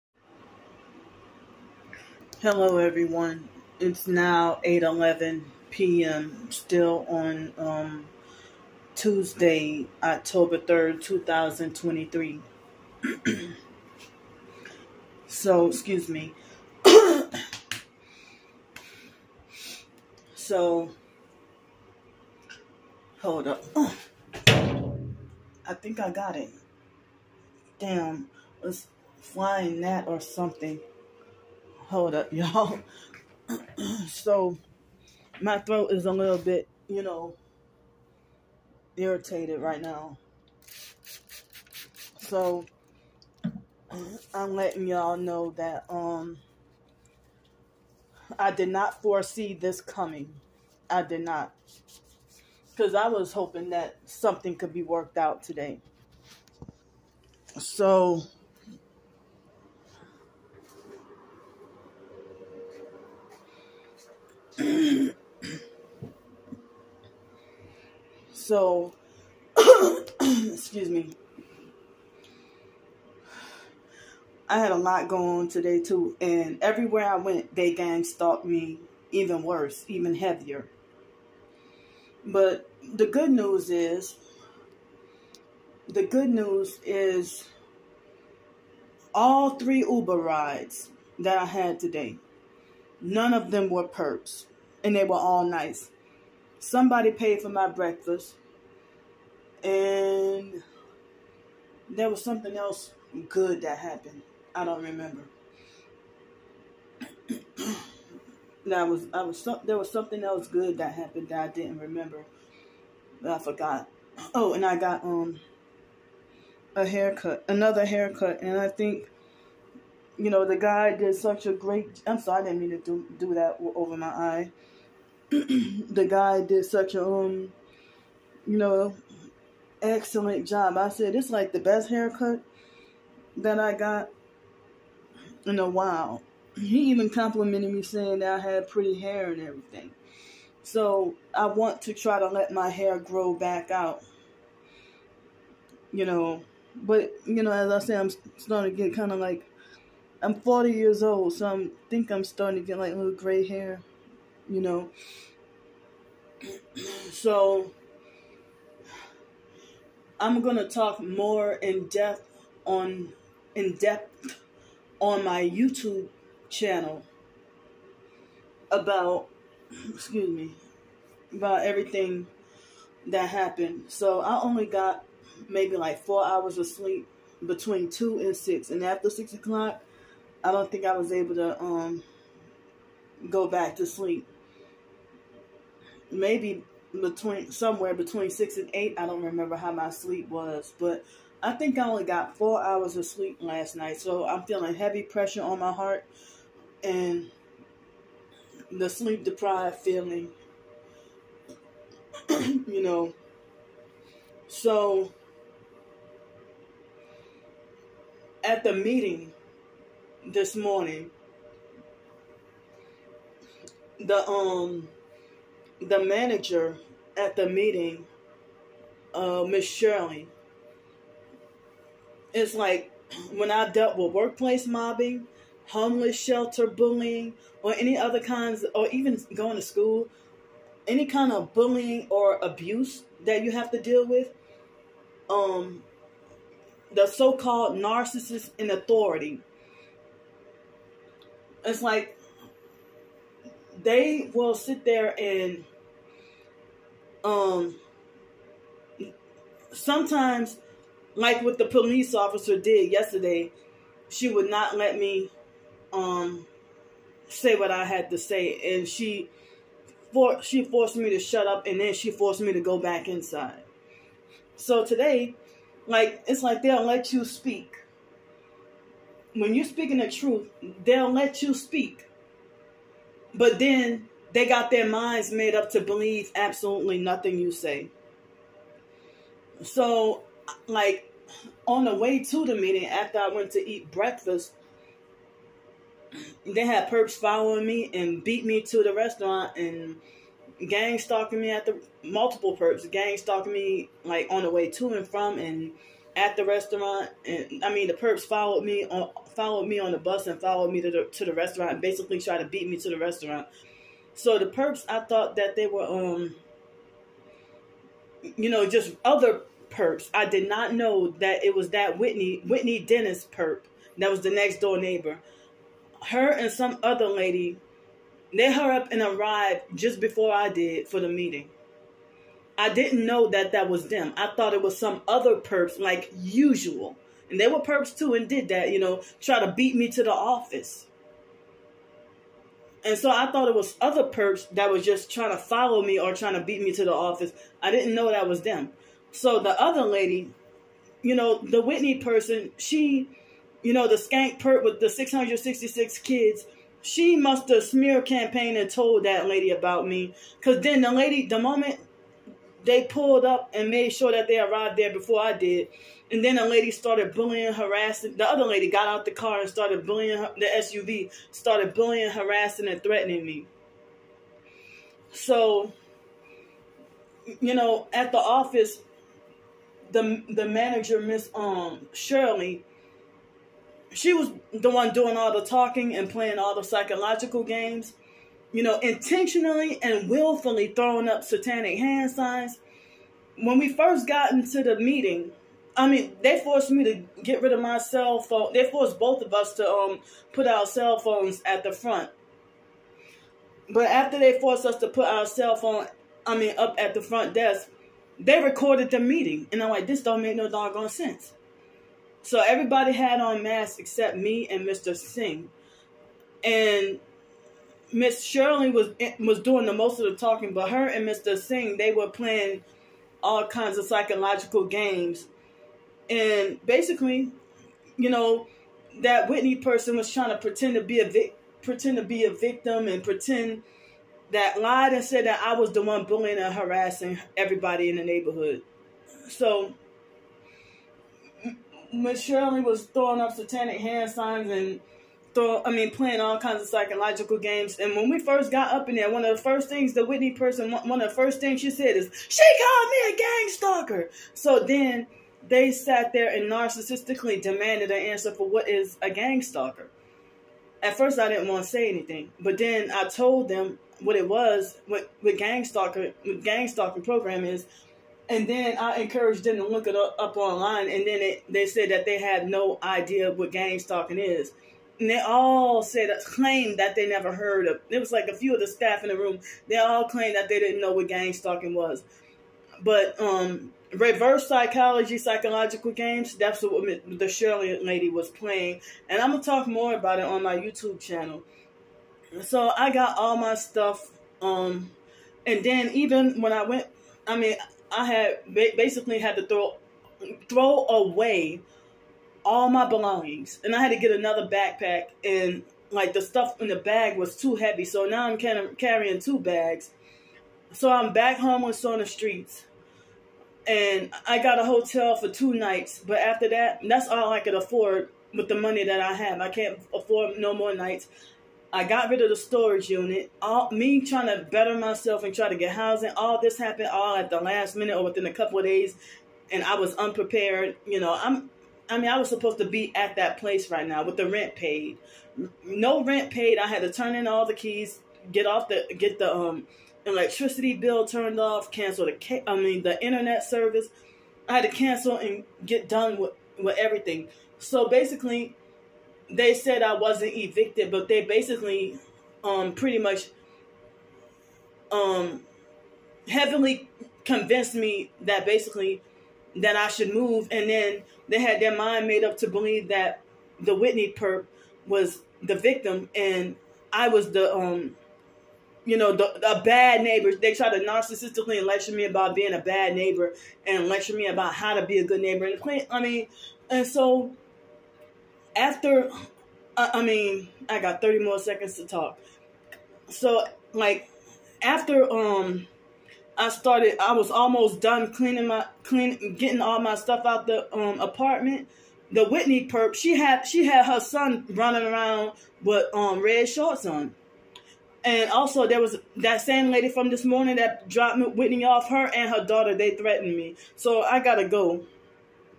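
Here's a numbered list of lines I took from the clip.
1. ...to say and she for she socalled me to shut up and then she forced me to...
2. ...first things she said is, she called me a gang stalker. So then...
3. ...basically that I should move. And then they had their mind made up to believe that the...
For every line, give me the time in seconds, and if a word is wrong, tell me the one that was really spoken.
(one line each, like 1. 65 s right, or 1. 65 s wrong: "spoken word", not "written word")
1. 258 s wrong: "forced", not "socalled"
2. 441 s right
3. 548 s right.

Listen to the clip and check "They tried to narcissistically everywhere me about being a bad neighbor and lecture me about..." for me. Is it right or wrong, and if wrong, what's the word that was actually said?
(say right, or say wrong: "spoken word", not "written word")
wrong: "lecture", not "everywhere".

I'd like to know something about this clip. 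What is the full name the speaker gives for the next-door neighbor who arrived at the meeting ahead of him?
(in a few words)
Whitney Dennis.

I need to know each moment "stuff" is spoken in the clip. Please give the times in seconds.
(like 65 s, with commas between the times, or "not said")
483 s, 496 s, 579 s.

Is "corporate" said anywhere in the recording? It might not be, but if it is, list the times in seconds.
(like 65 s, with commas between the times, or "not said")
not said.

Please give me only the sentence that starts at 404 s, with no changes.
Singh, and Miss Shirley was was doing the most of the talking, but her and Mr.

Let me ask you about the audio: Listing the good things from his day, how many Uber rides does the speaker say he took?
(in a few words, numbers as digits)
3.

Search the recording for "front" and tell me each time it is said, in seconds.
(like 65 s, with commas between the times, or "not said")
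391 s, 397 s.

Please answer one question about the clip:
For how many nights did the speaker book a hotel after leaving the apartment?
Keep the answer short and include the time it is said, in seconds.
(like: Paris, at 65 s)
2, at 505 s.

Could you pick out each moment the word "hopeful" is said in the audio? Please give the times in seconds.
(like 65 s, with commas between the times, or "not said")
not said.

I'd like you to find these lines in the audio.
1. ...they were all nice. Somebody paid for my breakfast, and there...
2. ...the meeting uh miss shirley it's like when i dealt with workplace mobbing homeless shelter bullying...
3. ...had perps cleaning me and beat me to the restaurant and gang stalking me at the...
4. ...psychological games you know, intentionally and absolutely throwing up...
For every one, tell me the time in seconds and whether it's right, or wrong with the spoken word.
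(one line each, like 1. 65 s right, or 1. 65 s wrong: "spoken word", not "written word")
1. 94 s right
2. 217 s right
3. 286 s wrong: "following", not "cleaning"
4. 376 s wrong: "willfully", not "absolutely".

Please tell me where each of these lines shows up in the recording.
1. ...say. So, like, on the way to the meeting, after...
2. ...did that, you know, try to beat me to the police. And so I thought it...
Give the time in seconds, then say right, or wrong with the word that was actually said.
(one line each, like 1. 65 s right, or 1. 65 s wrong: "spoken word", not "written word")
1. 277 s right
2. 328 s wrong: "office", not "police".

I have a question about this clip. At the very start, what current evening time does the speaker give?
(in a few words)
8:11 p.m.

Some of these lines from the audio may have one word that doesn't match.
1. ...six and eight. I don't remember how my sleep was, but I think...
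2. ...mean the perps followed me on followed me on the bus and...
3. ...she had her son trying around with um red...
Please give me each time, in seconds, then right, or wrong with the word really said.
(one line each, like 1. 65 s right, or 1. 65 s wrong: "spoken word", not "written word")
1. 188 s right
2. 297 s right
3. 583 s wrong: "running", not "trying".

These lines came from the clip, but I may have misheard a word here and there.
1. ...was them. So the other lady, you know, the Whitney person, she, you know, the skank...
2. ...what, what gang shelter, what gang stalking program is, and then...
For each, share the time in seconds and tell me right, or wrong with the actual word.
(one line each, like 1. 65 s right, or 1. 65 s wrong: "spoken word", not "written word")
1. 338 s right
2. 454 s wrong: "stalker", not "shelter".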